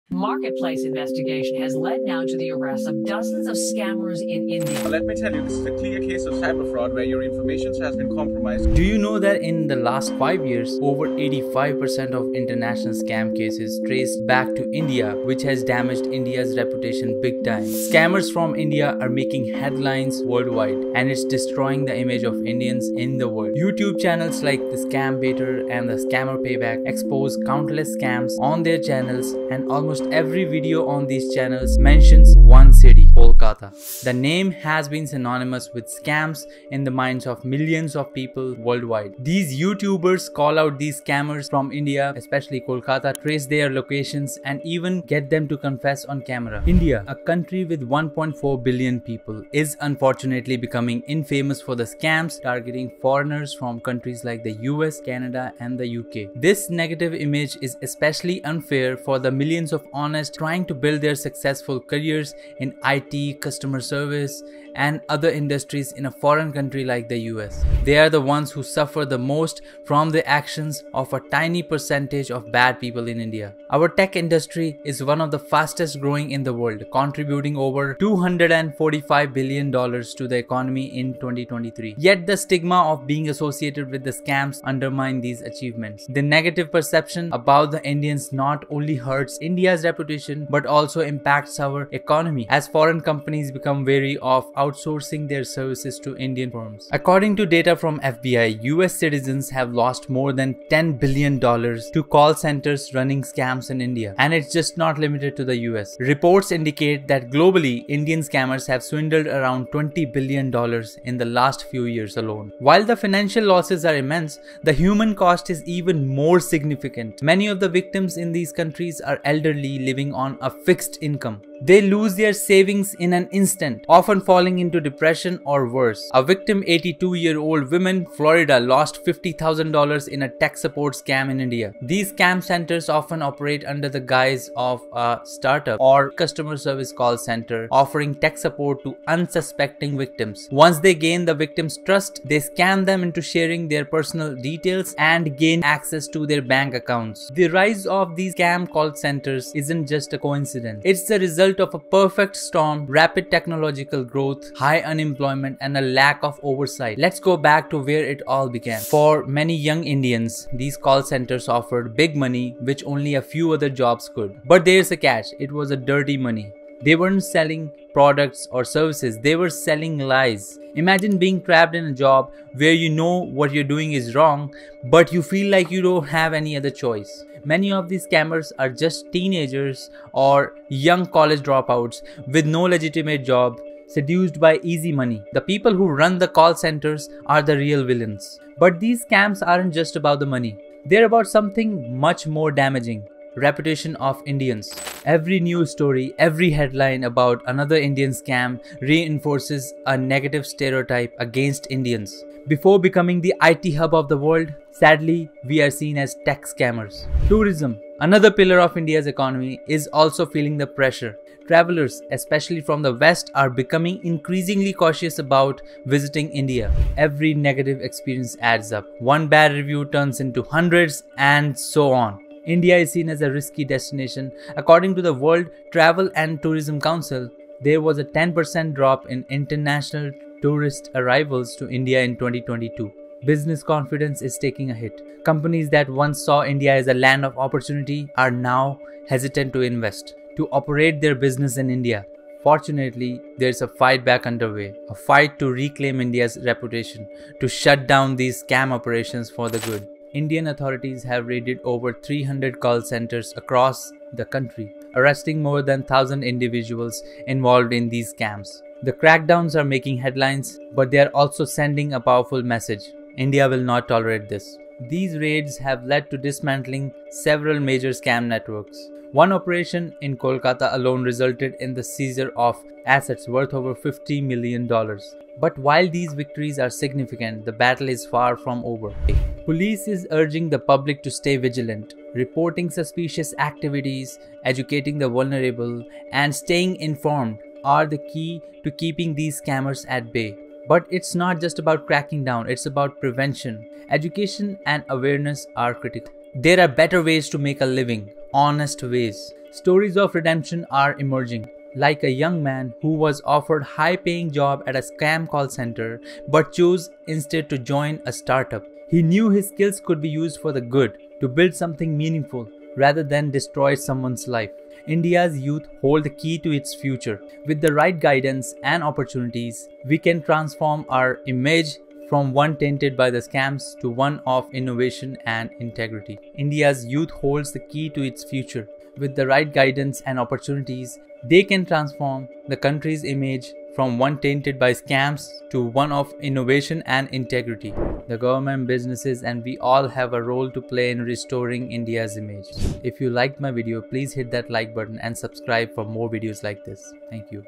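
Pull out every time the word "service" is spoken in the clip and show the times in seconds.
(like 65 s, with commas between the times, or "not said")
63 s, 95 s, 136 s, 168 s.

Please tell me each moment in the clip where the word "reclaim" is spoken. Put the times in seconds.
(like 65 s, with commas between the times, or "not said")
245 s.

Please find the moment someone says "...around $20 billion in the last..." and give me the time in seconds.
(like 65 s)
109 s.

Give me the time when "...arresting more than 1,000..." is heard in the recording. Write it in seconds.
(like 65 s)
254 s.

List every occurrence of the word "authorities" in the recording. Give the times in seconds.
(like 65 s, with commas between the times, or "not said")
250 s.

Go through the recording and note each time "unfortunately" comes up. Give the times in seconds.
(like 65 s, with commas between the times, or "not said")
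49 s.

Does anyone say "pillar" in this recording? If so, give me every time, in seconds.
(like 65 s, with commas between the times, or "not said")
208 s.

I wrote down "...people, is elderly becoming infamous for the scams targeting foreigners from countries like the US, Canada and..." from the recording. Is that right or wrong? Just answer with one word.
wrong.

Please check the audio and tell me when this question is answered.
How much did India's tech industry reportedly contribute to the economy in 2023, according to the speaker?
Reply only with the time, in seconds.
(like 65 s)
77 s.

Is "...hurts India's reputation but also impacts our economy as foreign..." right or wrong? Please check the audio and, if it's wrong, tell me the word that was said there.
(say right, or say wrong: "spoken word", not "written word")
right.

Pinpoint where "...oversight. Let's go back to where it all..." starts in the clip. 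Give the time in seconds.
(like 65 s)
156 s.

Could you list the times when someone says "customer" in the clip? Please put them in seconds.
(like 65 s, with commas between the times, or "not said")
63 s, 136 s.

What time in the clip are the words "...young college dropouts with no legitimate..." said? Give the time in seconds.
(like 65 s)
180 s.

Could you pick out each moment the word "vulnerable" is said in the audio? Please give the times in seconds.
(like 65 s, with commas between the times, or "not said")
285 s.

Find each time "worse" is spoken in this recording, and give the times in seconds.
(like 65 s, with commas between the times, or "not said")
125 s.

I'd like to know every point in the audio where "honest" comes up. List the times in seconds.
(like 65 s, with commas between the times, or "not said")
59 s, 298 s.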